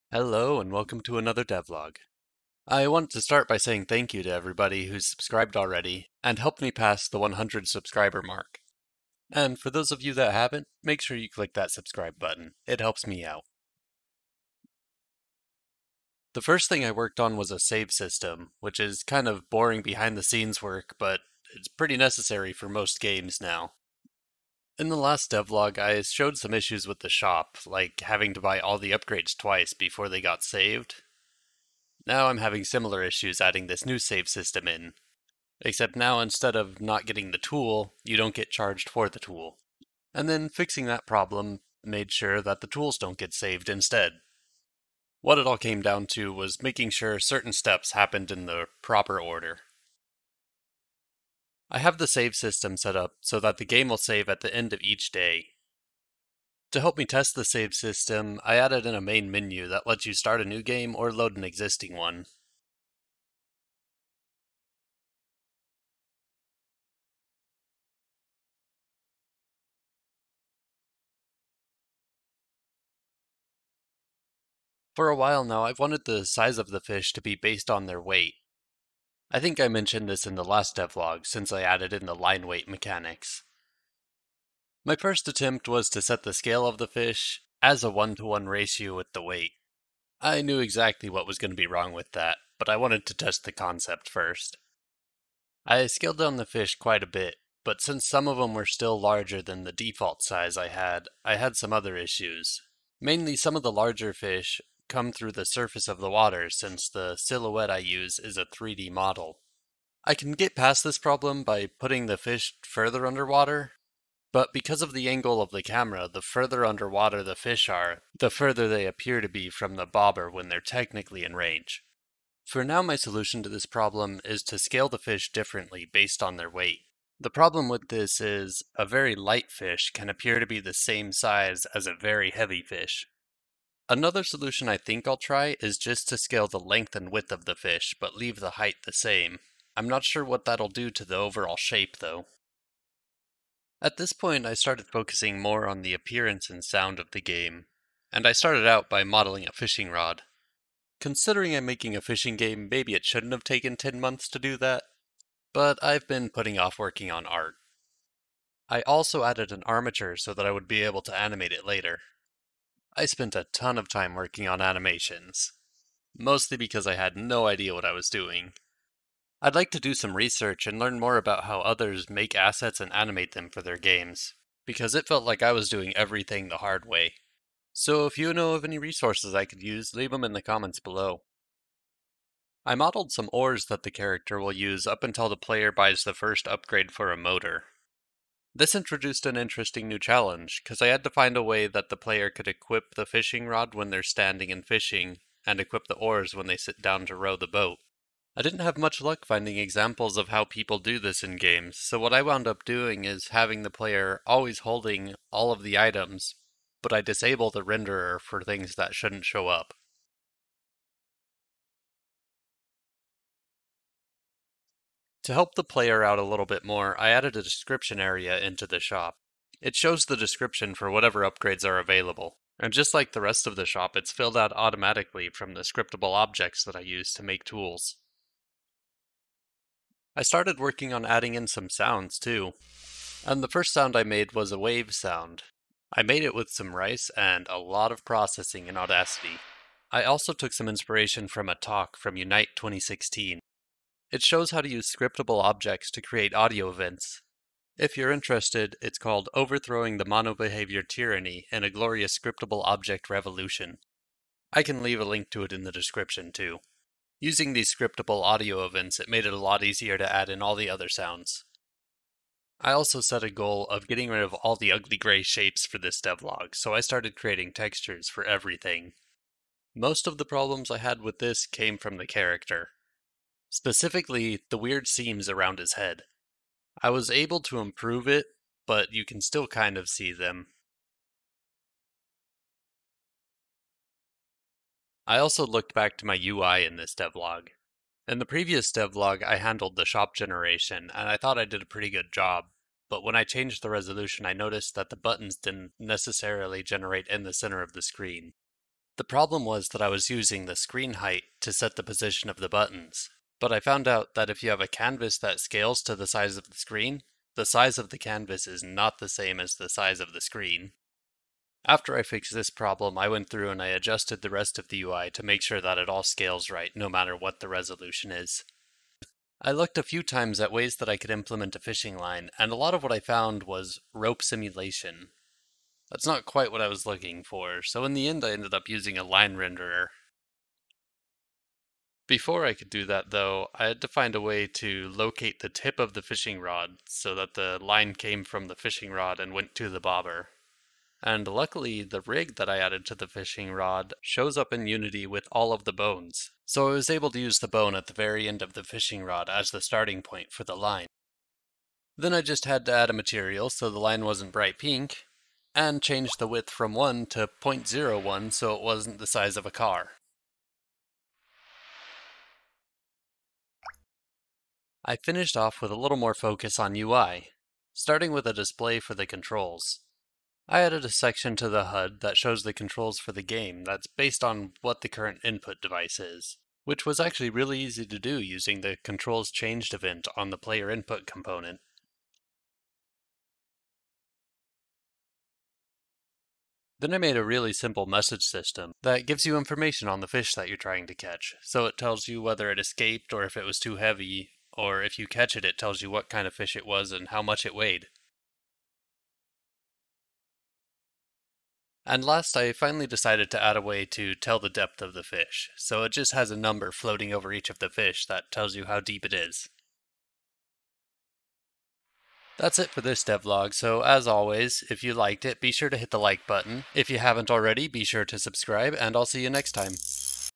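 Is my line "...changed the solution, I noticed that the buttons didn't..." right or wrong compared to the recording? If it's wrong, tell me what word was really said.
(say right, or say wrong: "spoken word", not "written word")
wrong: "resolution", not "solution".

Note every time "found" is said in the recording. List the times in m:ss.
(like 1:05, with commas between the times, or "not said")
5:03, 5:22.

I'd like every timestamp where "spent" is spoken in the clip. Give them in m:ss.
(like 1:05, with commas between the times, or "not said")
2:43.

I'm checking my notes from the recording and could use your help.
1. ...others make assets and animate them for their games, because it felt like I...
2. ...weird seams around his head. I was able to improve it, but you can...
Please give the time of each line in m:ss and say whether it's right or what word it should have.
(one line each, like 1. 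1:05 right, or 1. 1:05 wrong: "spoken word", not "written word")
1. 2:51 right
2. 4:34 right.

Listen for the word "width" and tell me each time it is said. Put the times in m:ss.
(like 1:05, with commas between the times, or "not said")
2:17, 5:56.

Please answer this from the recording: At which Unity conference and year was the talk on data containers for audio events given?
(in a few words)
Unite 2016.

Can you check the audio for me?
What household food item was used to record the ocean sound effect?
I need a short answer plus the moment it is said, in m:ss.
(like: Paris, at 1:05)
Rice, at 3:56.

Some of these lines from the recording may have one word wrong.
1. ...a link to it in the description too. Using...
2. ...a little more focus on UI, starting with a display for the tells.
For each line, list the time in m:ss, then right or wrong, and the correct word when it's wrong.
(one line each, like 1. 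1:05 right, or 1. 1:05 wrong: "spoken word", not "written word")
1. 4:14 right
2. 6:05 wrong: "controls", not "tells".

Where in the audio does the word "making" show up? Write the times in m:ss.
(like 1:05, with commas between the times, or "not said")
0:46, 2:31.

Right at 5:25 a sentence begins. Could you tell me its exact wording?
That's not quite what I was looking for, so in the end I ended up using a line renderer.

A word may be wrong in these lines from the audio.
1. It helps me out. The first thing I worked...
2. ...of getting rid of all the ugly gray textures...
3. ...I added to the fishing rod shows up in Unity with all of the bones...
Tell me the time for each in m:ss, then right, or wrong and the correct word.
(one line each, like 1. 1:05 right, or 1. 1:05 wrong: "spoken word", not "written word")
1. 0:12 right
2. 4:23 wrong: "shapes", not "textures"
3. 5:42 right.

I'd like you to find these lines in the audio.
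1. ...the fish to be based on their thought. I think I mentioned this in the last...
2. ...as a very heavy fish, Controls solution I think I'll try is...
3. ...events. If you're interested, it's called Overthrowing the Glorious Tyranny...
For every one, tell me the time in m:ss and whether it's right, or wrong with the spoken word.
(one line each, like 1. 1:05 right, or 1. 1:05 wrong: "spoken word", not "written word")
1. 1:16 wrong: "weight", not "thought"
2. 2:11 wrong: "Another", not "Controls"
3. 4:06 wrong: "MonoBehaviour", not "Glorious".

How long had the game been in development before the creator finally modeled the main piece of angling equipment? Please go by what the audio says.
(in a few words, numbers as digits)
10 months.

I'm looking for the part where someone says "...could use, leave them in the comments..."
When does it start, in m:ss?
2:59.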